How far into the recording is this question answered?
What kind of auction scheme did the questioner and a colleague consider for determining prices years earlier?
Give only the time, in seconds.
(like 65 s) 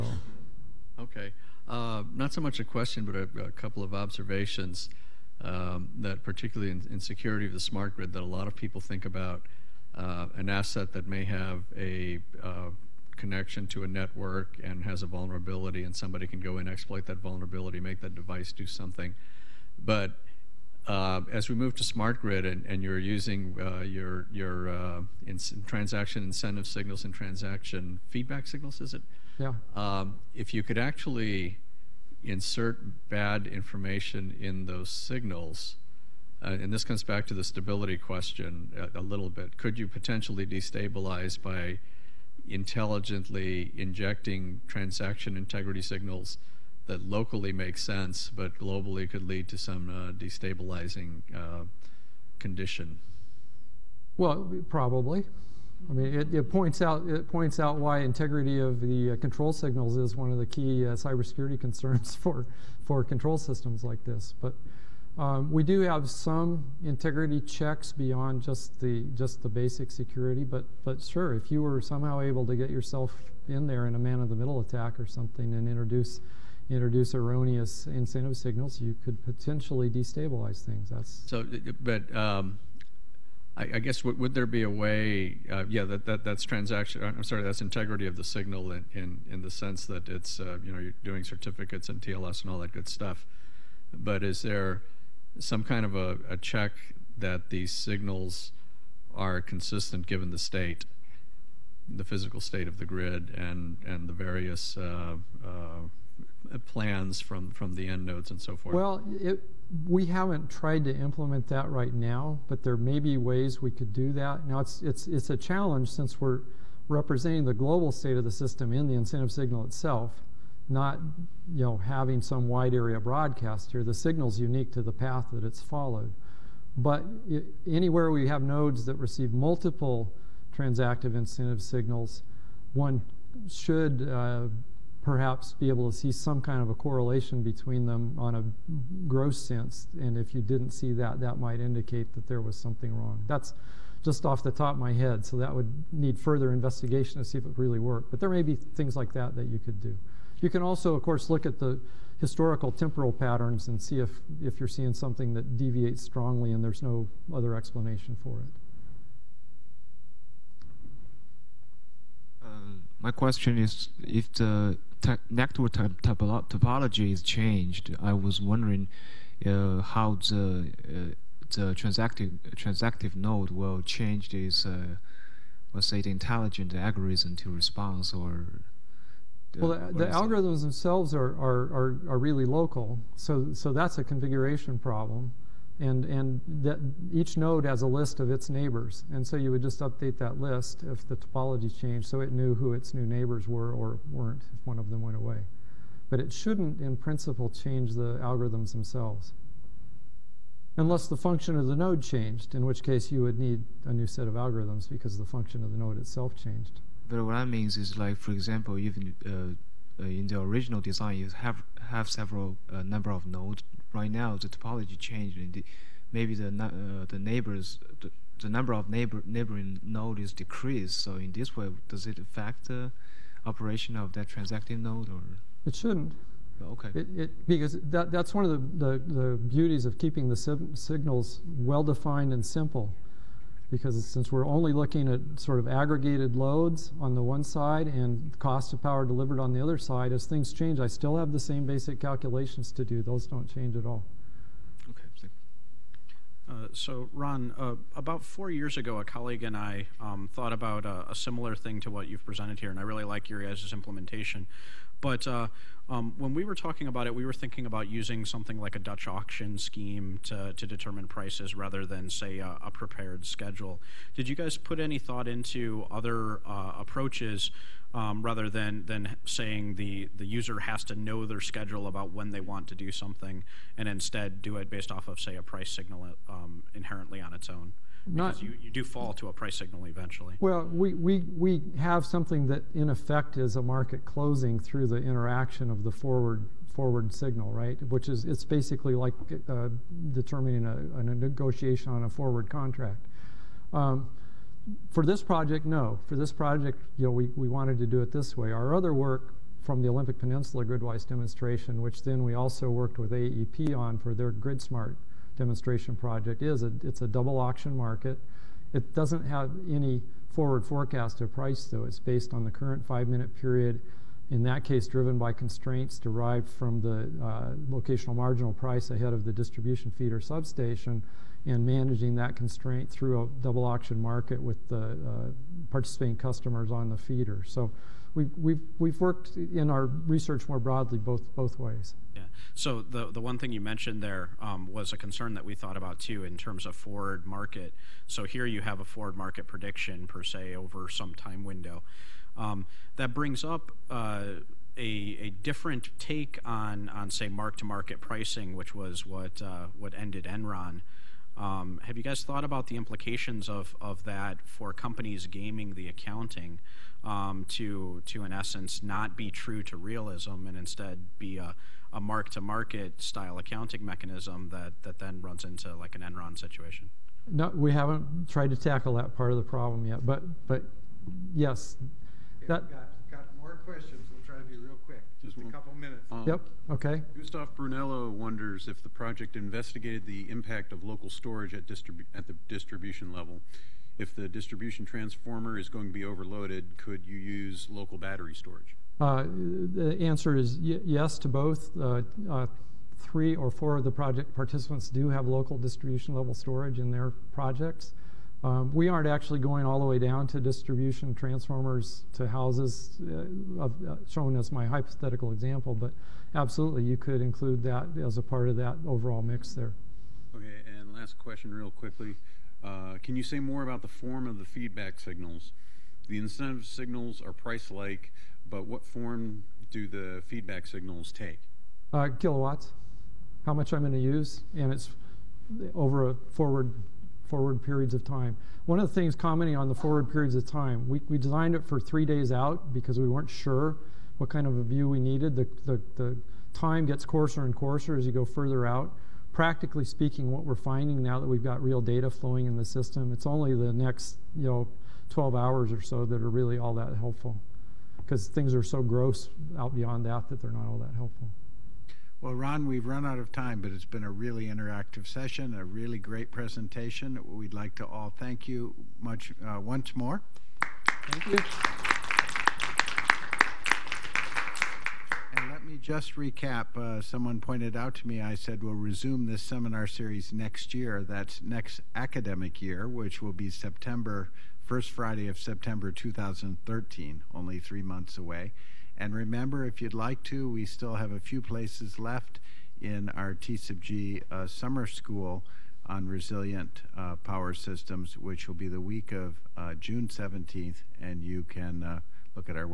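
258 s.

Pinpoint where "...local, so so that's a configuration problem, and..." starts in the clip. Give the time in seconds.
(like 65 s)
182 s.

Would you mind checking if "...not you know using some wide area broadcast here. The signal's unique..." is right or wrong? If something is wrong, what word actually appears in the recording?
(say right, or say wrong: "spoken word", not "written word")
wrong: "having", not "using".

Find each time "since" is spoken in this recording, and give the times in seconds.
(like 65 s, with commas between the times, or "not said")
115 s, 234 s.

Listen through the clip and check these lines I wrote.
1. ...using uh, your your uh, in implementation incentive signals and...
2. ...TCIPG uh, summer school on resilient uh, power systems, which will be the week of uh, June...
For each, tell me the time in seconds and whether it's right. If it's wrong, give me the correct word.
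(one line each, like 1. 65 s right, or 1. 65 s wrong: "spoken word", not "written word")
1. 22 s wrong: "transaction", not "implementation"
2. 483 s right.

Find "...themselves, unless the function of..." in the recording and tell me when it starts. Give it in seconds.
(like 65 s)
198 s.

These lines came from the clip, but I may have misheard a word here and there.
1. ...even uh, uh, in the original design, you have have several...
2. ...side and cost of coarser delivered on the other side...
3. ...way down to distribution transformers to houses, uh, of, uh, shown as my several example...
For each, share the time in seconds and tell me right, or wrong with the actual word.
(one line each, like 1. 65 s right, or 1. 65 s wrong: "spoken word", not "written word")
1. 208 s right
2. 237 s wrong: "power", not "coarser"
3. 399 s wrong: "hypothetical", not "several".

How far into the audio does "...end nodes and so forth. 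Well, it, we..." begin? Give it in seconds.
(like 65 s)
107 s.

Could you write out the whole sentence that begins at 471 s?
That's next academic year, which will be September first Friday of September 2013, only three months away.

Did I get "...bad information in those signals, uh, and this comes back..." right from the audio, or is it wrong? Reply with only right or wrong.
right.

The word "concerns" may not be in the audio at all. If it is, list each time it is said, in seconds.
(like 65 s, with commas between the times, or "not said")
61 s, 334 s.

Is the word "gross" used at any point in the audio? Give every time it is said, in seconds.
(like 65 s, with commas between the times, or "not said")
139 s, 448 s.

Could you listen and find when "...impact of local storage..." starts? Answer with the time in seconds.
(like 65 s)
380 s.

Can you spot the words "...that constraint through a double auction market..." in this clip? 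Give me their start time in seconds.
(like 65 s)
322 s.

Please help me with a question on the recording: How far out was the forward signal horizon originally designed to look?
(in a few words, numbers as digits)
3 days.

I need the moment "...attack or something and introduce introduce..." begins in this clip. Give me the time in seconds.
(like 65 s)
74 s.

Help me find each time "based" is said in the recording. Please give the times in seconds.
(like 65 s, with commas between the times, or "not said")
274 s, 311 s.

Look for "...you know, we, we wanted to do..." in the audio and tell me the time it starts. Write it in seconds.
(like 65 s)
296 s.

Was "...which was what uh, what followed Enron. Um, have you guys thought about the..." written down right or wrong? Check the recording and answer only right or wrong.
wrong.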